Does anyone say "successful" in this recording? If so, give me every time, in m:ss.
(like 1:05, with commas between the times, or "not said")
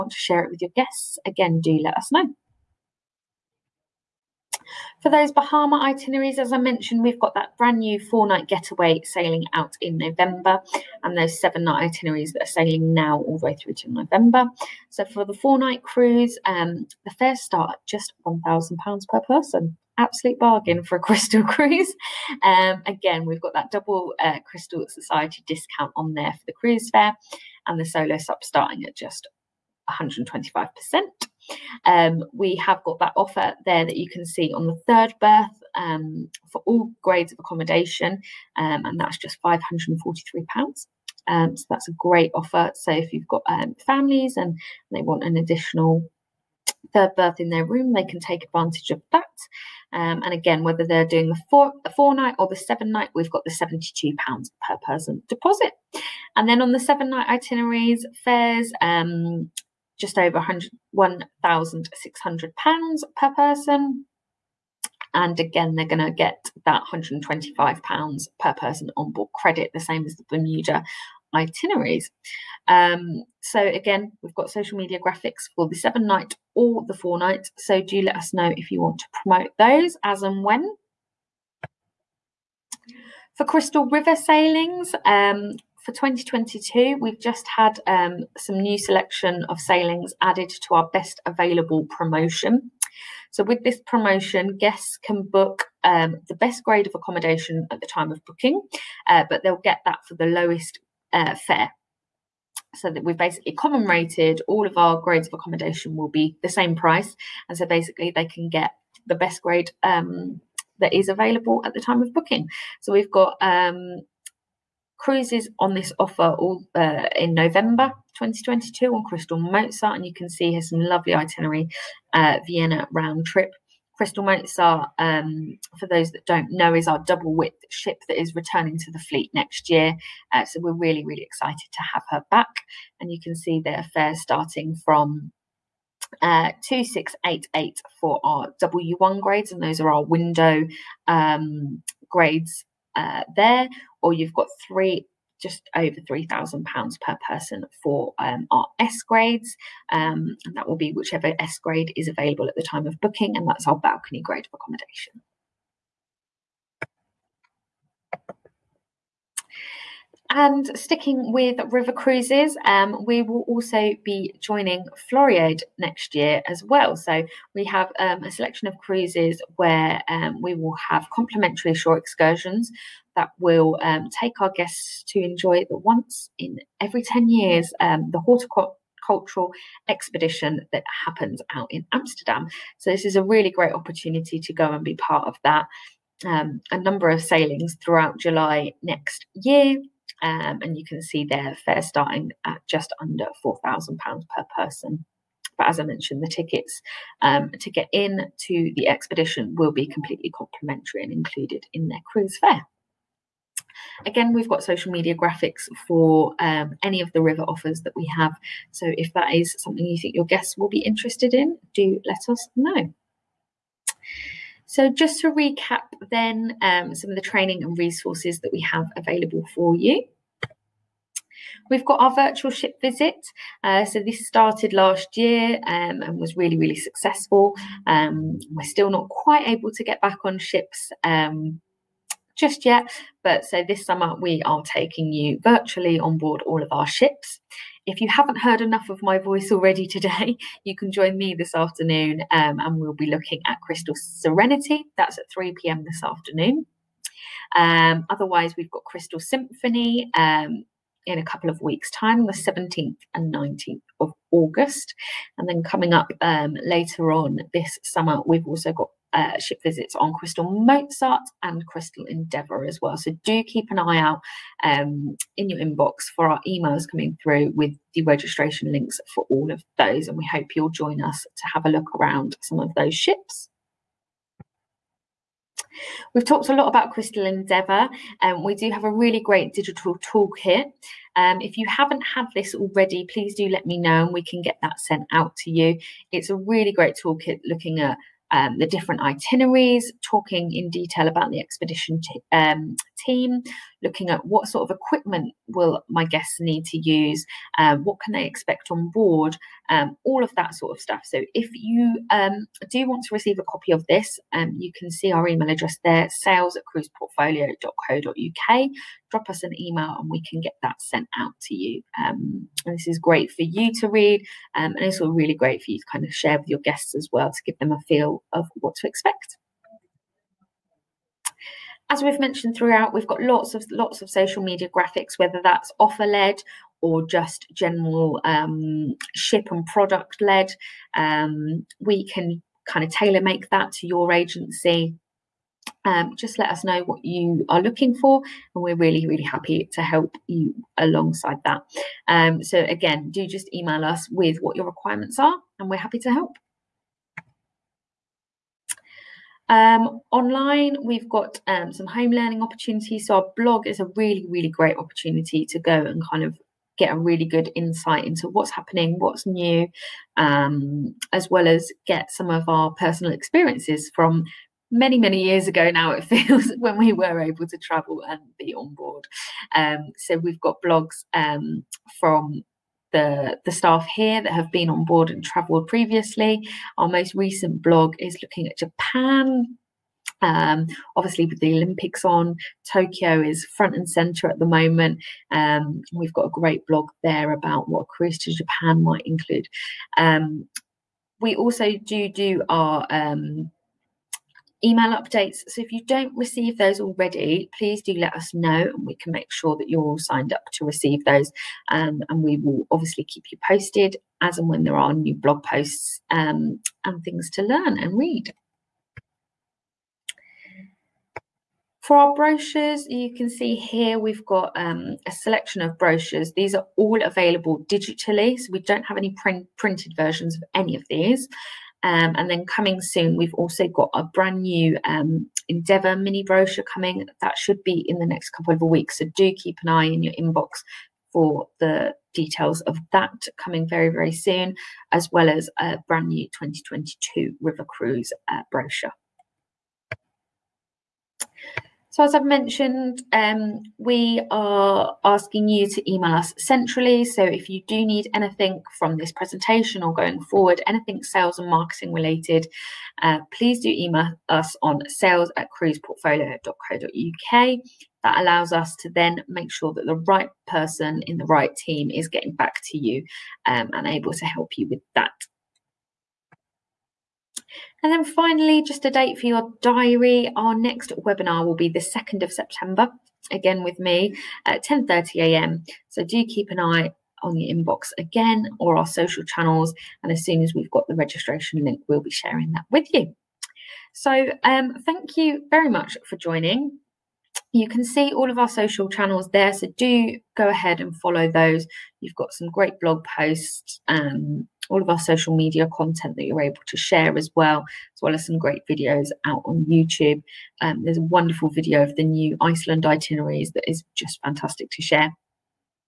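3:46.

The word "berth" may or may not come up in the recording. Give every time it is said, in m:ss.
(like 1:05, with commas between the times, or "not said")
0:35, 0:47.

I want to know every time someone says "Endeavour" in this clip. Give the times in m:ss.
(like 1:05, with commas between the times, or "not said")
4:22, 4:37, 7:05.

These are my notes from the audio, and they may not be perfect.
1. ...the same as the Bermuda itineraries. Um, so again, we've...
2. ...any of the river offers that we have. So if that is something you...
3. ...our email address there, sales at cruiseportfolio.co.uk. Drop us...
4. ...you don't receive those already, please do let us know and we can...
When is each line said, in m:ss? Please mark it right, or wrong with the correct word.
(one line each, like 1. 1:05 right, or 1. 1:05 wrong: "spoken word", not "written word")
1. 1:09 right
2. 3:26 right
3. 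5:05 right
4. 6:35 right.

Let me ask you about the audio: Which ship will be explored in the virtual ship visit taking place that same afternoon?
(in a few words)
Crystal Serenity.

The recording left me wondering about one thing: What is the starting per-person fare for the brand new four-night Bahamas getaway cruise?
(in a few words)
£1,000.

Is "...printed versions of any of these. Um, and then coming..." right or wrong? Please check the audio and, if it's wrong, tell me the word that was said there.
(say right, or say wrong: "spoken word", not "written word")
right.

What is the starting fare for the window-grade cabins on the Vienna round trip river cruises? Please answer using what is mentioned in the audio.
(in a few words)
2688.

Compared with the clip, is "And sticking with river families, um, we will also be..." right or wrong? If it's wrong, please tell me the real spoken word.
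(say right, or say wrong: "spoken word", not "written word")
wrong: "cruises", not "families".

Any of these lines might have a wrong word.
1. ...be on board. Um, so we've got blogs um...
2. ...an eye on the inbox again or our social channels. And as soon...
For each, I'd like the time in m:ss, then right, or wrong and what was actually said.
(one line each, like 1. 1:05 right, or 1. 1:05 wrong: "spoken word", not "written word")
1. 6:08 right
2. 7:56 right.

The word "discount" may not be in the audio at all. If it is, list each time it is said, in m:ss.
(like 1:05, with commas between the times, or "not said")
0:25.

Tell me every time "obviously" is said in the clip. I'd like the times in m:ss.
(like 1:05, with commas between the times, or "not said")
6:20, 6:42.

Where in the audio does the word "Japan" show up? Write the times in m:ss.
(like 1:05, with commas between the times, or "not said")
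6:18, 6:28.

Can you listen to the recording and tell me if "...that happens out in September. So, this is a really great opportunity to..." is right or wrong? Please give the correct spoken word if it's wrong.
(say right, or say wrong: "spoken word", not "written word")
wrong: "Amsterdam", not "September".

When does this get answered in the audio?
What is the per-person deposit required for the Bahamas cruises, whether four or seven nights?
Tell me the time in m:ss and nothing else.
0:53.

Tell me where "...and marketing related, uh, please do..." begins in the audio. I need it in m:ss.
7:31.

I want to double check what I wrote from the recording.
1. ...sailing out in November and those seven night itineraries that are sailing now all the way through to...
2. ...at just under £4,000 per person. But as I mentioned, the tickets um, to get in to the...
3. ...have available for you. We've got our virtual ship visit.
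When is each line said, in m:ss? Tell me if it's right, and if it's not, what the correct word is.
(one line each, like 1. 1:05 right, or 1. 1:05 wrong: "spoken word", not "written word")
1. 0:09 right
2. 3:12 right
3. 3:38 right.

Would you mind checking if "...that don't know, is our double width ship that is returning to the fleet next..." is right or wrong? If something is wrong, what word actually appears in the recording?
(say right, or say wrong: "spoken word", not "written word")
right.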